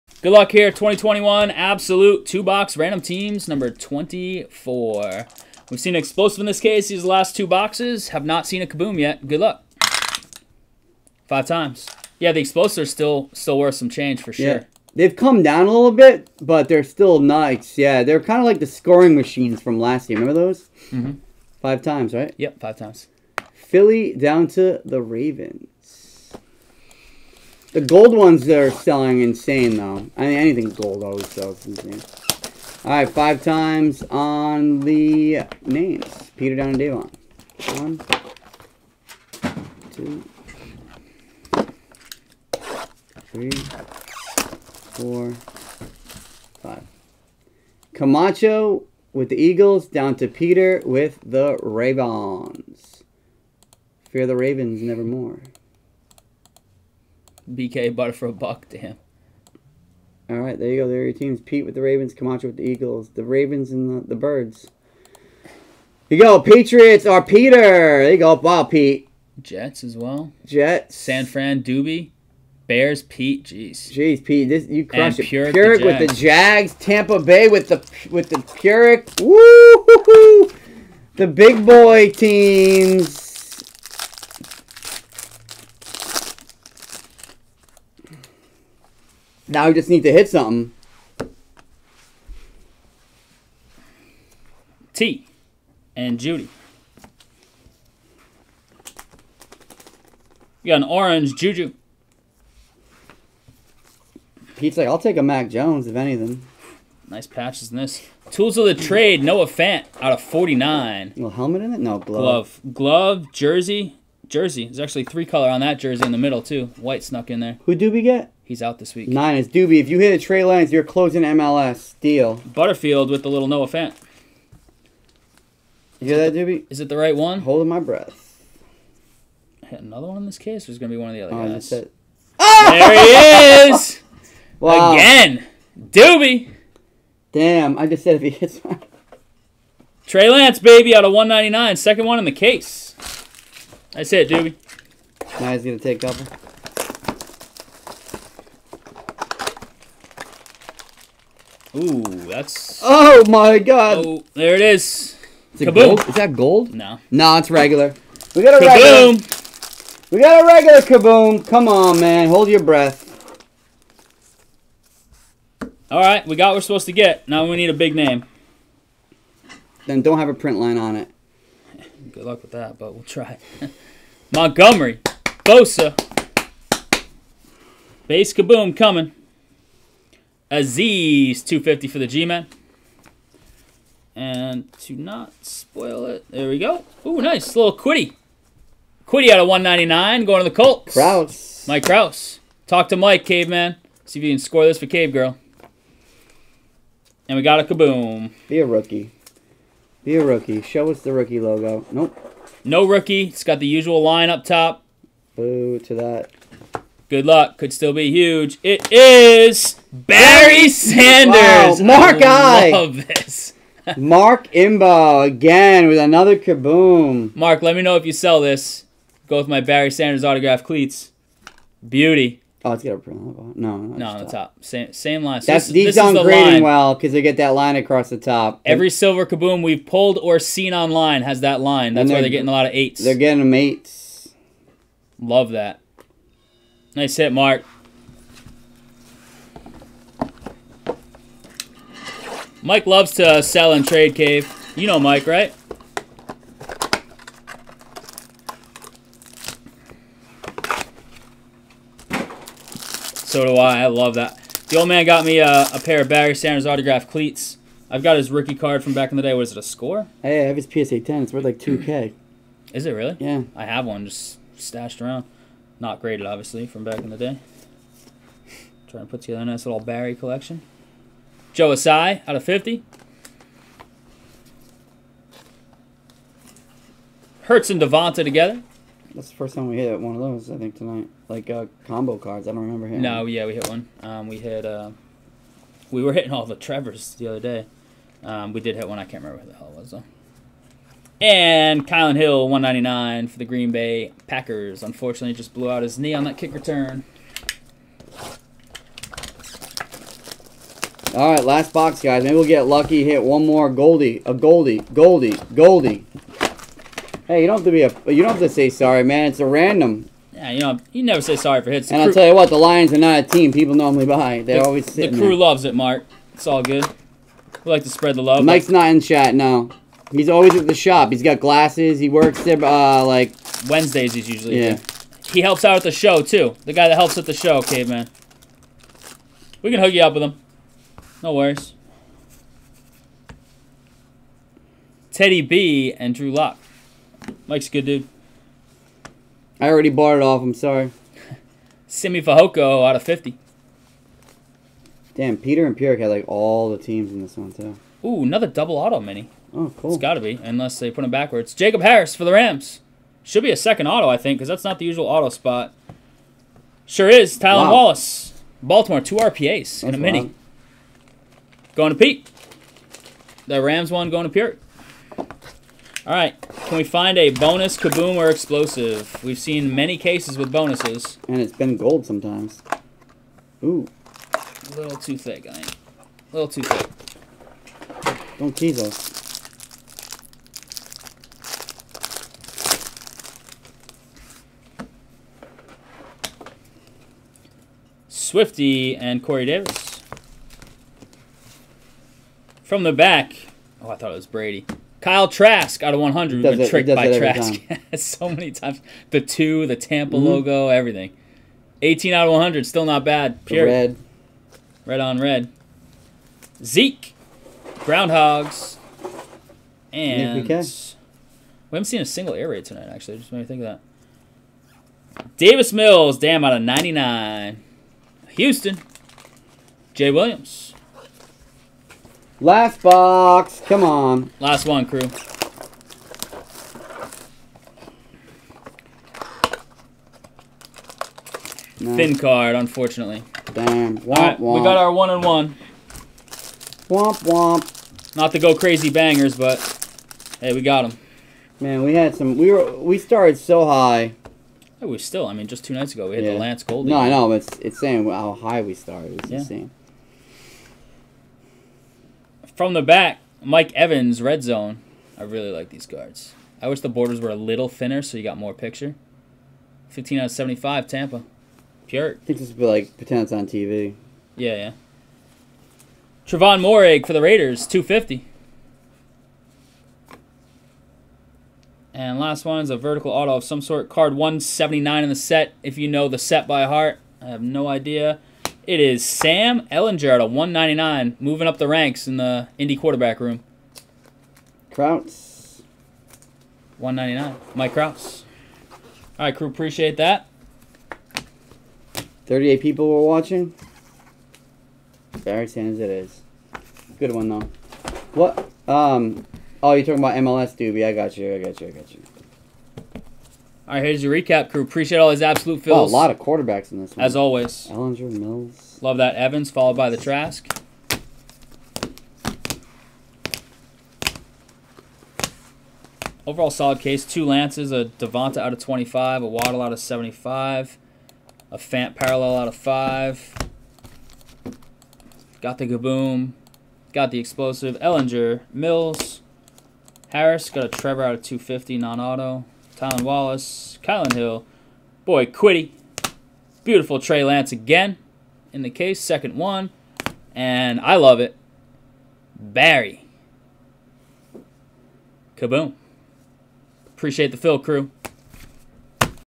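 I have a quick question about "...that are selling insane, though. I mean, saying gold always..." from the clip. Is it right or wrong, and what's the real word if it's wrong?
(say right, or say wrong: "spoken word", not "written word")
wrong: "anything", not "saying".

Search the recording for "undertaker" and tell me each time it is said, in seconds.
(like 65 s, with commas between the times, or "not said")
not said.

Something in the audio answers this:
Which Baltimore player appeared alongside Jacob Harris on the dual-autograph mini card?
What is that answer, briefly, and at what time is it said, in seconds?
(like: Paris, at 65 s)
Tylan Wallace, at 357 s.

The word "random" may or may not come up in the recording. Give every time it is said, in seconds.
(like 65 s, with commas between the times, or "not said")
2 s, 309 s.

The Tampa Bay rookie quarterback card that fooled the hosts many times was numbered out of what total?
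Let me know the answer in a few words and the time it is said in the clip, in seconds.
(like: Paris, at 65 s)
100, at 395 s.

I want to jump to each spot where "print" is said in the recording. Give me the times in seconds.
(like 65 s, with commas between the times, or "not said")
170 s, 222 s.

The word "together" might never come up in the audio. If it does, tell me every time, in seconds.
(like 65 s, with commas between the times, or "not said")
269 s, 278 s.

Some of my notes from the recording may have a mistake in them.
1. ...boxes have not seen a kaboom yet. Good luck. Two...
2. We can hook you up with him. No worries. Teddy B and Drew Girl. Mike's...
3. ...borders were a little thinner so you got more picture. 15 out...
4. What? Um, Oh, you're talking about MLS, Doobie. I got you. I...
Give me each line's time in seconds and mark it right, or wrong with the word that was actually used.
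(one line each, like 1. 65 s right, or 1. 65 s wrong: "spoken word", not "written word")
1. 7 s wrong: "Five", not "Two"
2. 329 s wrong: "Lock", not "Girl"
3. 456 s right
4. 498 s right.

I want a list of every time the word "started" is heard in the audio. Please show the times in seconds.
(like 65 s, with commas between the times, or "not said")
442 s, 448 s.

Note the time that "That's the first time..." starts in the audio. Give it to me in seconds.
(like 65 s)
279 s.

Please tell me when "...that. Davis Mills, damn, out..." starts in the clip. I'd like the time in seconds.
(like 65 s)
413 s.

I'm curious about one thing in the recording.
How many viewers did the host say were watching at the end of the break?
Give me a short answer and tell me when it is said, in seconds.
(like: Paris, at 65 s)
38, at 492 s.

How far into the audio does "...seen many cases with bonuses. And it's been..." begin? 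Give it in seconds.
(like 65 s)
369 s.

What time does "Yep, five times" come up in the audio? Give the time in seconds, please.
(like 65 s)
22 s.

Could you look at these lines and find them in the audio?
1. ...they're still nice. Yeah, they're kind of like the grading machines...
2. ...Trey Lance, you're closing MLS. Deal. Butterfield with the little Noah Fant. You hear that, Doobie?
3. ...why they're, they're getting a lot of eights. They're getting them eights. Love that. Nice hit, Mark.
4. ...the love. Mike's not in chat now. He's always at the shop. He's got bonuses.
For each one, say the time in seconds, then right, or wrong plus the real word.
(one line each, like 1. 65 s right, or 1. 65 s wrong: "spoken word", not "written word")
1. 16 s wrong: "scoring", not "grading"
2. 120 s right
3. 232 s right
4. 318 s wrong: "glasses", not "bonuses".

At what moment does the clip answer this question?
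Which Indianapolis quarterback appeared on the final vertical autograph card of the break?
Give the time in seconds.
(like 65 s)
479 s.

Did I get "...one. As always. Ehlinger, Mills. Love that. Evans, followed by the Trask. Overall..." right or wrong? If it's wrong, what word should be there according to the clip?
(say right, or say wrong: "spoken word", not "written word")
right.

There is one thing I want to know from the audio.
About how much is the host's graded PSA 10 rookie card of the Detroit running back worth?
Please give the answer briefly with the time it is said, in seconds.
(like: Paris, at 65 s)
2K, at 261 s.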